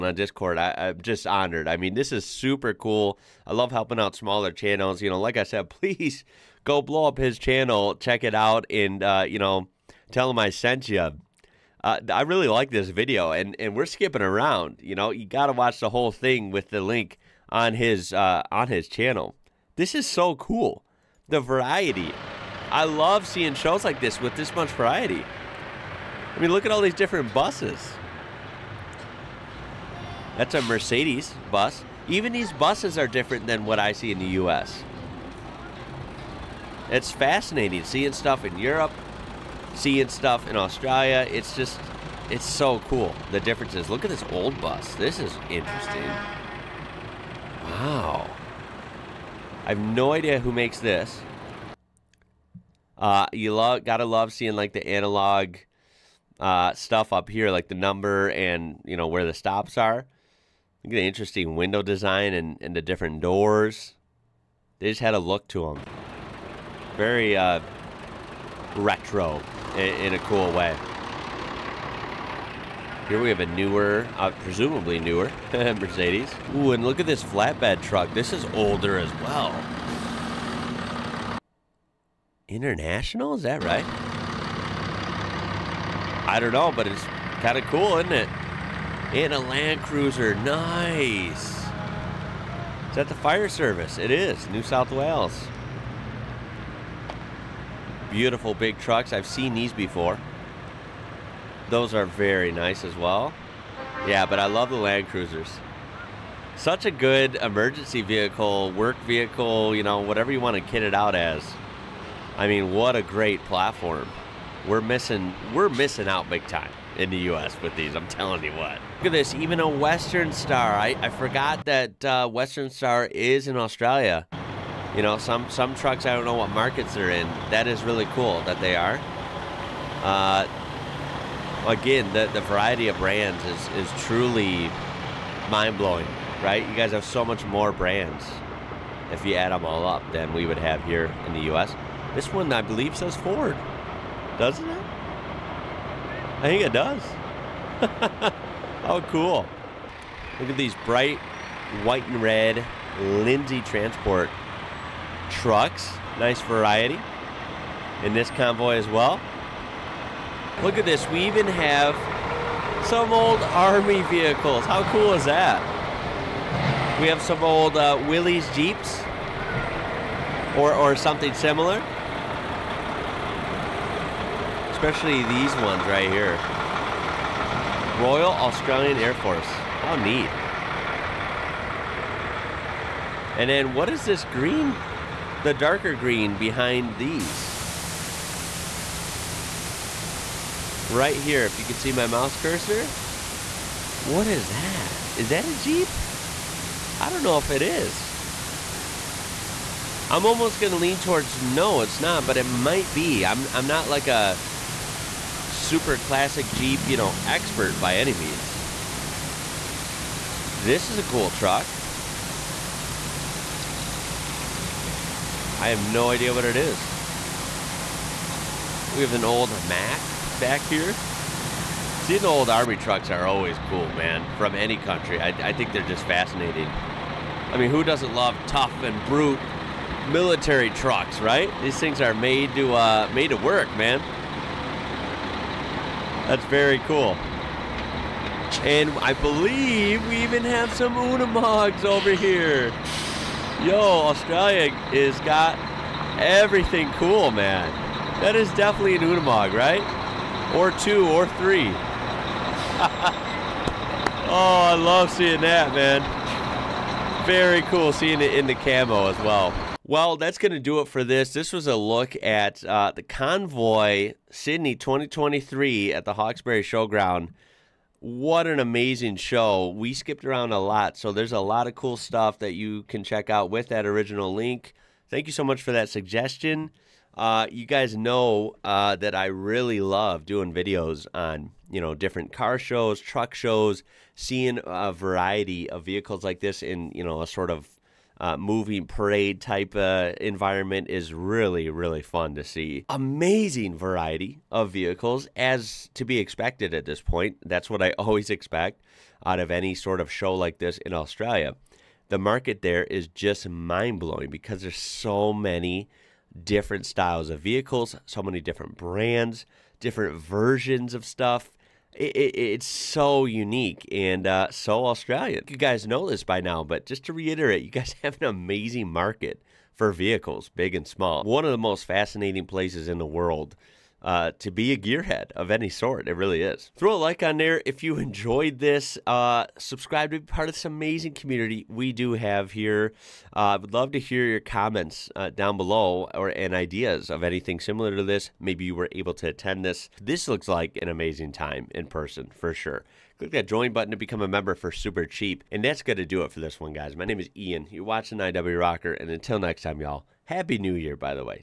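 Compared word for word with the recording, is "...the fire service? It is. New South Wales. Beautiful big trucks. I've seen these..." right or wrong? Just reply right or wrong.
right.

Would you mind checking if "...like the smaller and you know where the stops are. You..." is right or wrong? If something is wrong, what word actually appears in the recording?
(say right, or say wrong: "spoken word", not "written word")
wrong: "number", not "smaller".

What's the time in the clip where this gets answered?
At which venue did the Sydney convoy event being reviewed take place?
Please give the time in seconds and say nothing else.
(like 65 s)
266 s.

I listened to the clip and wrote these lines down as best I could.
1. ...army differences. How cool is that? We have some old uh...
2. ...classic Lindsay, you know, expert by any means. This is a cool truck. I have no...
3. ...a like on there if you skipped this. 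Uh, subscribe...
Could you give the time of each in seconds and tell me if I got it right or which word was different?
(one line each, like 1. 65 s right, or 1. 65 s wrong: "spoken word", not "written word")
1. 163 s wrong: "vehicles", not "differences"
2. 205 s wrong: "Jeep", not "Lindsay"
3. 326 s wrong: "enjoyed", not "skipped".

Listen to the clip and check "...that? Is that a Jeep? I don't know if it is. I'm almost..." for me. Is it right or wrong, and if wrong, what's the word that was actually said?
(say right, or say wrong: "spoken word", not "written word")
right.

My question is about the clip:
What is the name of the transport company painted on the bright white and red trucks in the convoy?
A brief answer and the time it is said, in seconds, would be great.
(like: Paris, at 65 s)
Lindsay Transport, at 153 s.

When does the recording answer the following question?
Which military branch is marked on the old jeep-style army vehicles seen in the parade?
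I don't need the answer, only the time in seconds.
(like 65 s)
178 s.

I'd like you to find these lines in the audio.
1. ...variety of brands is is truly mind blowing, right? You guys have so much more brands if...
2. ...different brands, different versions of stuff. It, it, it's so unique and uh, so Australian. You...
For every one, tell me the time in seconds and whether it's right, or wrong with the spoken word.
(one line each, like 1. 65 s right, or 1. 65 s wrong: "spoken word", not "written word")
1. 132 s right
2. 308 s right.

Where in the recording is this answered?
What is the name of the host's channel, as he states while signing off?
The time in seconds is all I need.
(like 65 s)
348 s.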